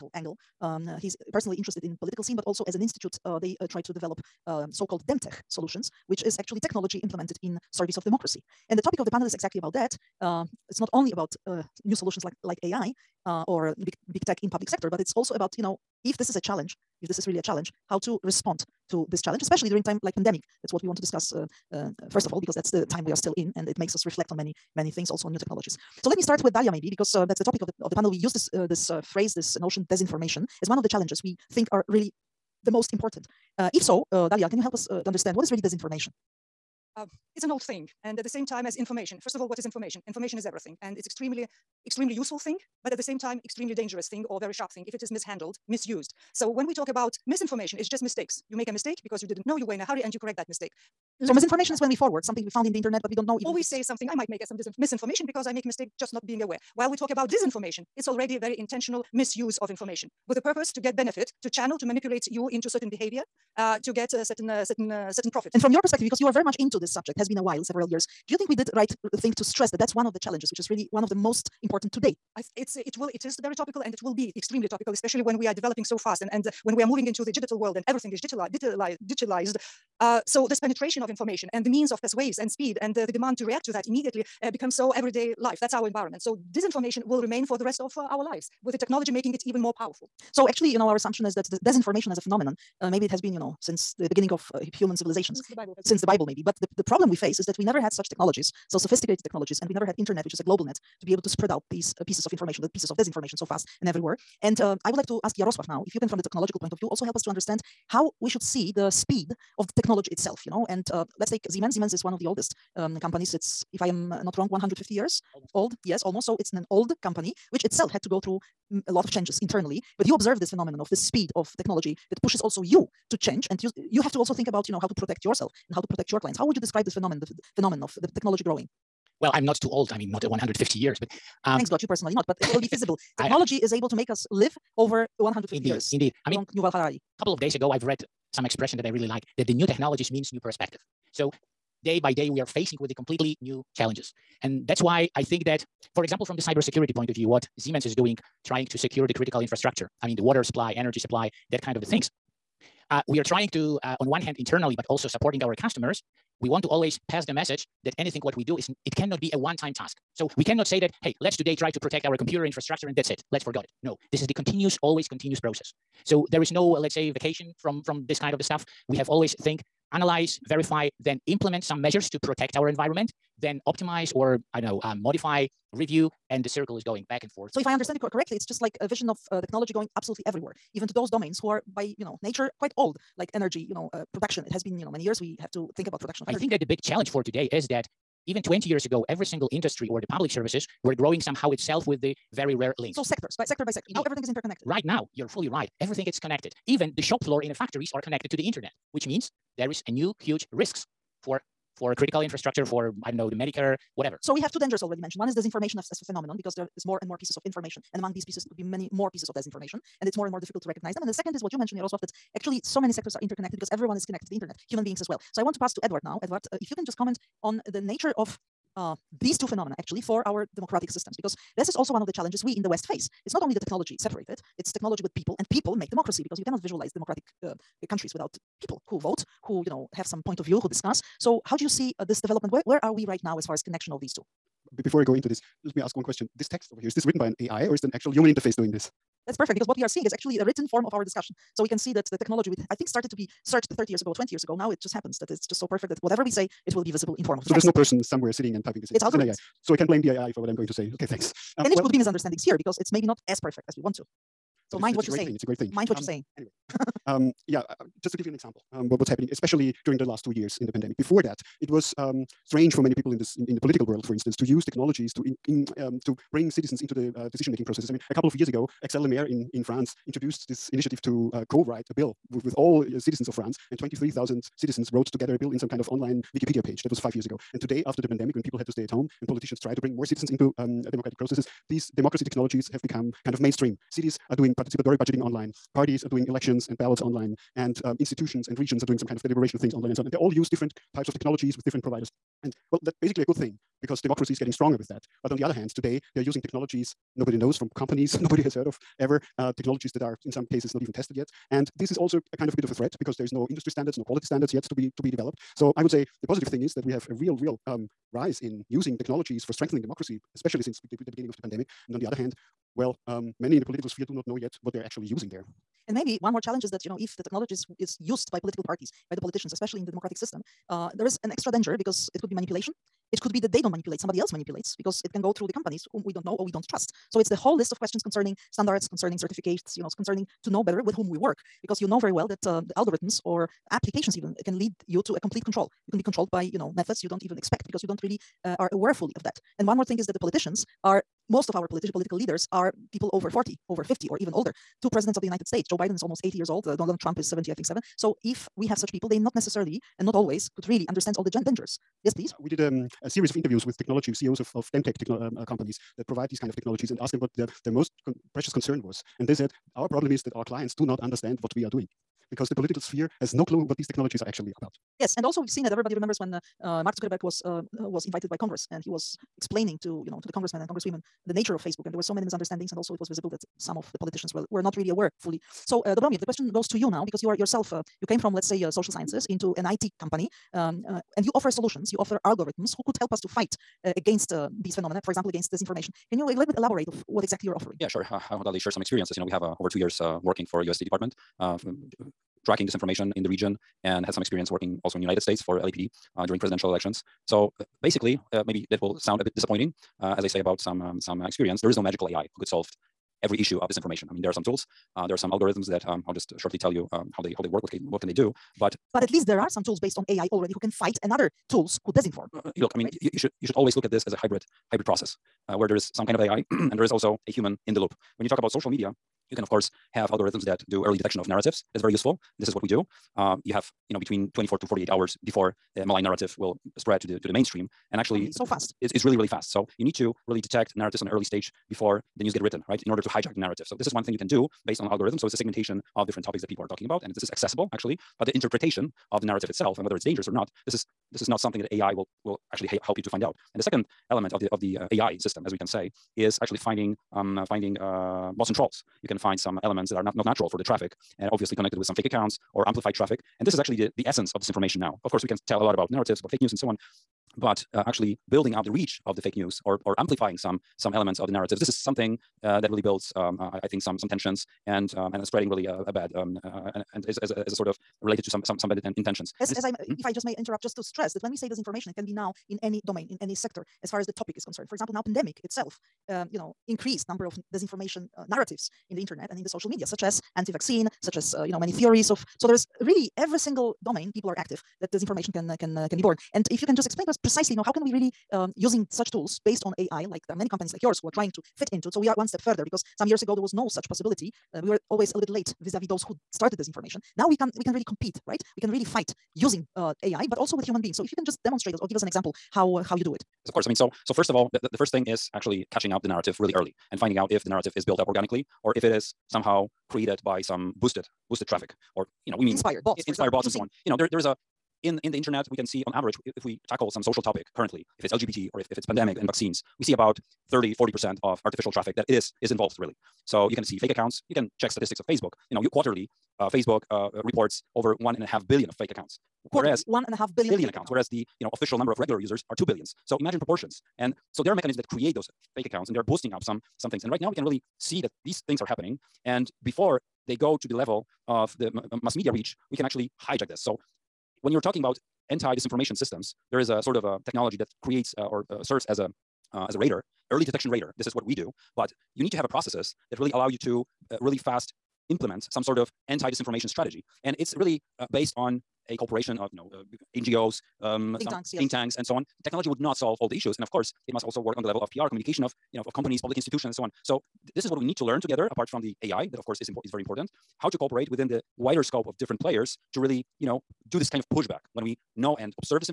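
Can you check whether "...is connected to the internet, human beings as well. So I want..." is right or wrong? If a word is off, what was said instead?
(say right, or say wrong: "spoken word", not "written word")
right.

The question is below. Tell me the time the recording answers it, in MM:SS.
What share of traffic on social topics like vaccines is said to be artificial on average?
08:40.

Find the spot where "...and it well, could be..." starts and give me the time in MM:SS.
04:11.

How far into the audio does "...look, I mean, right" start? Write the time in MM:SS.
06:52.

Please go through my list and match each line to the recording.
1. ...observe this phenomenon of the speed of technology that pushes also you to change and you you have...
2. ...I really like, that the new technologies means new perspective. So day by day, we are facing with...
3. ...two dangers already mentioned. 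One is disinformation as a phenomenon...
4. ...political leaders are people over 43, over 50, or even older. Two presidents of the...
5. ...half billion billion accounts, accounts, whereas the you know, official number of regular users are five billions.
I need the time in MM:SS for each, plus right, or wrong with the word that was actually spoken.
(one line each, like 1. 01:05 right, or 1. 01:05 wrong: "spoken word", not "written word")
1. 02:00 right
2. 02:18 right
3. 03:24 right
4. 05:41 wrong: "40", not "43"
5. 08:50 wrong: "two", not "five".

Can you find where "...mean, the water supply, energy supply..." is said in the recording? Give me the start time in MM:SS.
02:30.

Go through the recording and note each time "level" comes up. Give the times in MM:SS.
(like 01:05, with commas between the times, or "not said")
09:00, 09:24.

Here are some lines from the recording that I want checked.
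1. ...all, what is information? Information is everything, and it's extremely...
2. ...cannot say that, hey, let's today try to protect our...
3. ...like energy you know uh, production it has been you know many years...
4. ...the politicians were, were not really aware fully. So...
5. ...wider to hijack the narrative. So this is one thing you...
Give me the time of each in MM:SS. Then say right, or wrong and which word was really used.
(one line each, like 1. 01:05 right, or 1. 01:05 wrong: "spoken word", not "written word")
1. 00:39 right
2. 02:40 right
3. 03:03 right
4. 06:13 right
5. 07:12 wrong: "order", not "wider".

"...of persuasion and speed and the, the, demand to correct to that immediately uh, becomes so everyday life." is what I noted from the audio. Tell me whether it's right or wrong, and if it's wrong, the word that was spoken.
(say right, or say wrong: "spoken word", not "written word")
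wrong: "react", not "correct".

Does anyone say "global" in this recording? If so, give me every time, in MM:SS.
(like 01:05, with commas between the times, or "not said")
01:40.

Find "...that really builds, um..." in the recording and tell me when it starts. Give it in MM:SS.
07:42.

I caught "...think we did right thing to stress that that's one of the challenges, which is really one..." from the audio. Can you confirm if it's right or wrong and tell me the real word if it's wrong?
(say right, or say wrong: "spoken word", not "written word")
right.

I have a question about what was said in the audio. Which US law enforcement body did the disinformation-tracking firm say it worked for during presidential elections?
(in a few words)
LAPD.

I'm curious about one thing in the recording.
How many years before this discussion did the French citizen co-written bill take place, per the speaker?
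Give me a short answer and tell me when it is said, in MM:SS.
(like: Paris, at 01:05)
5 years, at 04:36.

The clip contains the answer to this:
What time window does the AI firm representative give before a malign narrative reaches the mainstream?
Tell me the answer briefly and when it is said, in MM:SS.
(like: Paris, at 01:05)
24 to 48 hours, at 07:04.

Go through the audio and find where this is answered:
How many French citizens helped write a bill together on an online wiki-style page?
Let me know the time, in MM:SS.
04:33.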